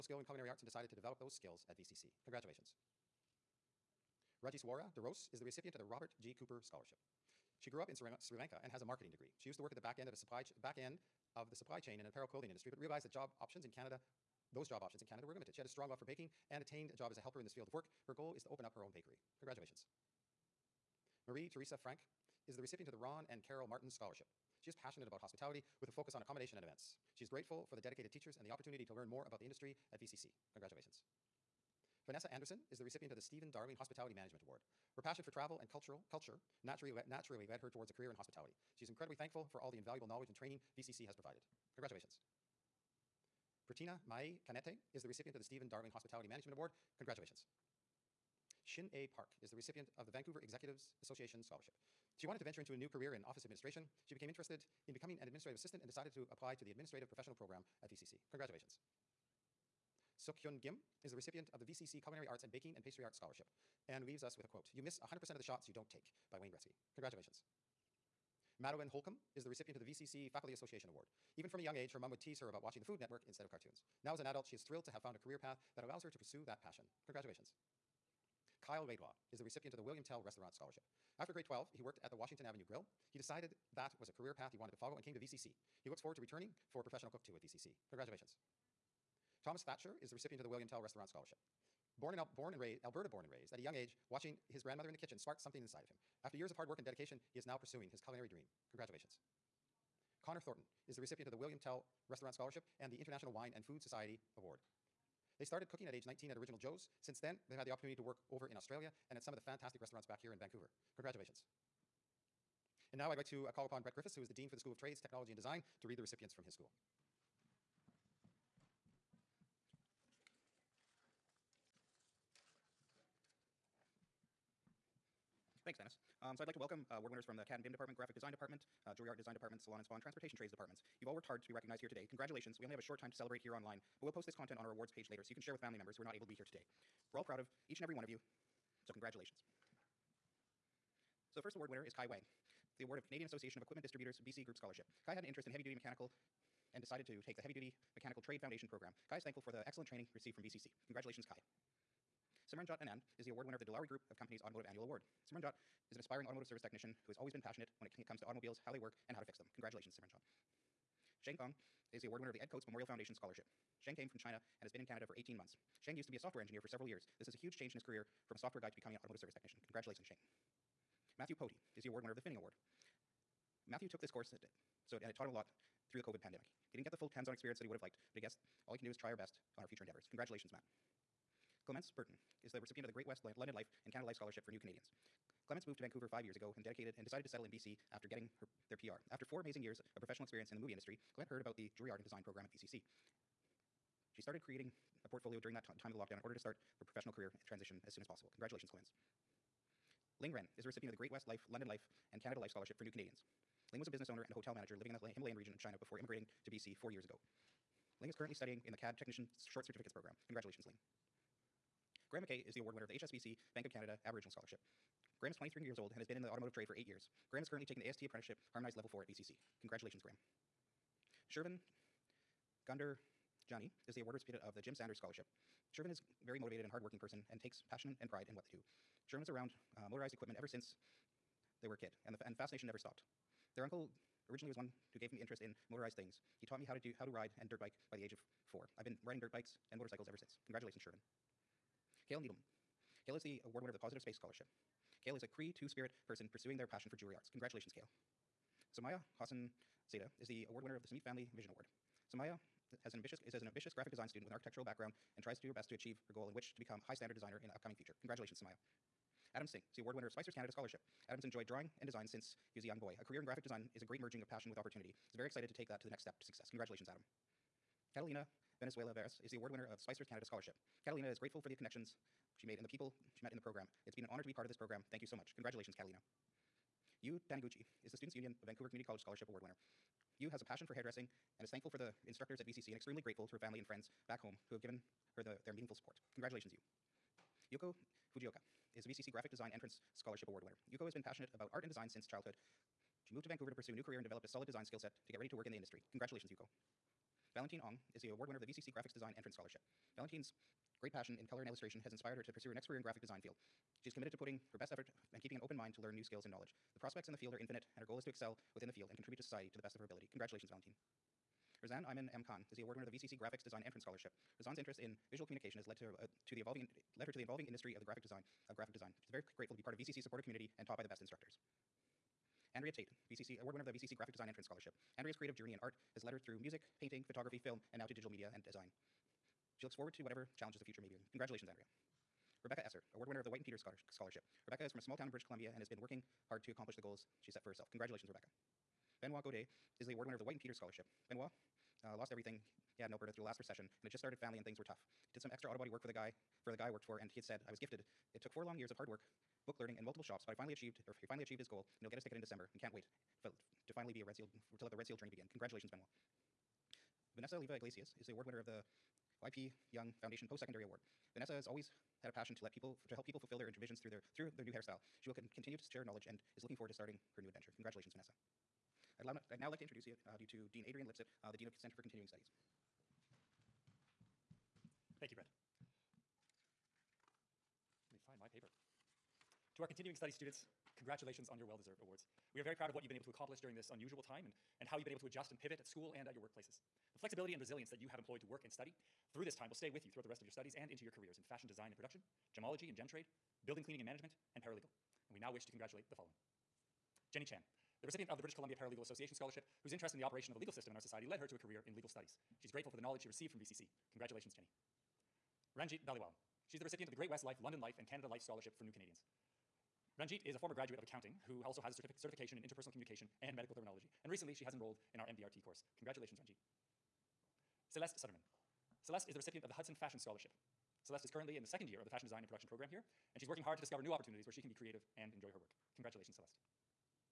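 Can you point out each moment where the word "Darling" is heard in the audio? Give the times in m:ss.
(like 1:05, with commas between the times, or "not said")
0:33, 0:45.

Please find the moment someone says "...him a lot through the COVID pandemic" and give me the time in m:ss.
2:55.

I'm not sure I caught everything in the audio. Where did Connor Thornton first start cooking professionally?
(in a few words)
Original Joe's.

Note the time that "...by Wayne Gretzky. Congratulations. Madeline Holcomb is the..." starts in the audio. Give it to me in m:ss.
1:06.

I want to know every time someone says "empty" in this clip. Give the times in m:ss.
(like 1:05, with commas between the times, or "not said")
not said.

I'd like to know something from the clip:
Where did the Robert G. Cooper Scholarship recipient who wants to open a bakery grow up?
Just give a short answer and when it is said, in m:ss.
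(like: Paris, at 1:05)
Sri Lanka, at 0:07.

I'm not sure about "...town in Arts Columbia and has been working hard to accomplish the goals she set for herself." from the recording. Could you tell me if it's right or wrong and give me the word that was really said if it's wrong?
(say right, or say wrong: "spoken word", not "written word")
wrong: "British", not "Arts".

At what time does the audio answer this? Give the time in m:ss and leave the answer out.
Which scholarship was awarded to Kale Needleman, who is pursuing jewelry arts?
4:03.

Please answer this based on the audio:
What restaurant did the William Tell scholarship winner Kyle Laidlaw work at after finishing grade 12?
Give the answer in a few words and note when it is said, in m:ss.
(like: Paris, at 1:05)
Washington Avenue Grill, at 1:22.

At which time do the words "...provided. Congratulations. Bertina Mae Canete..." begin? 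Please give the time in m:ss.
0:41.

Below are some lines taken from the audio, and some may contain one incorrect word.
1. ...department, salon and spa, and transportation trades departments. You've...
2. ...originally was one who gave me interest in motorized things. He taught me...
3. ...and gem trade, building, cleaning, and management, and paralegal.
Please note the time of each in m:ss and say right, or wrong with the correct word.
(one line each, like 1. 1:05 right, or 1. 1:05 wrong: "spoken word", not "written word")
1. 2:09 right
2. 3:54 right
3. 6:32 right.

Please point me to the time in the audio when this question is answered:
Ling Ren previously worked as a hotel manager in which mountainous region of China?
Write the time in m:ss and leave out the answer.
3:25.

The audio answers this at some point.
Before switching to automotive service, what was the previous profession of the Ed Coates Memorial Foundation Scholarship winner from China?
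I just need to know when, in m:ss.
2:46.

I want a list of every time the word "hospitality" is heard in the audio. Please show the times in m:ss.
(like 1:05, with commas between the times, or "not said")
0:25, 0:33, 0:38, 0:45.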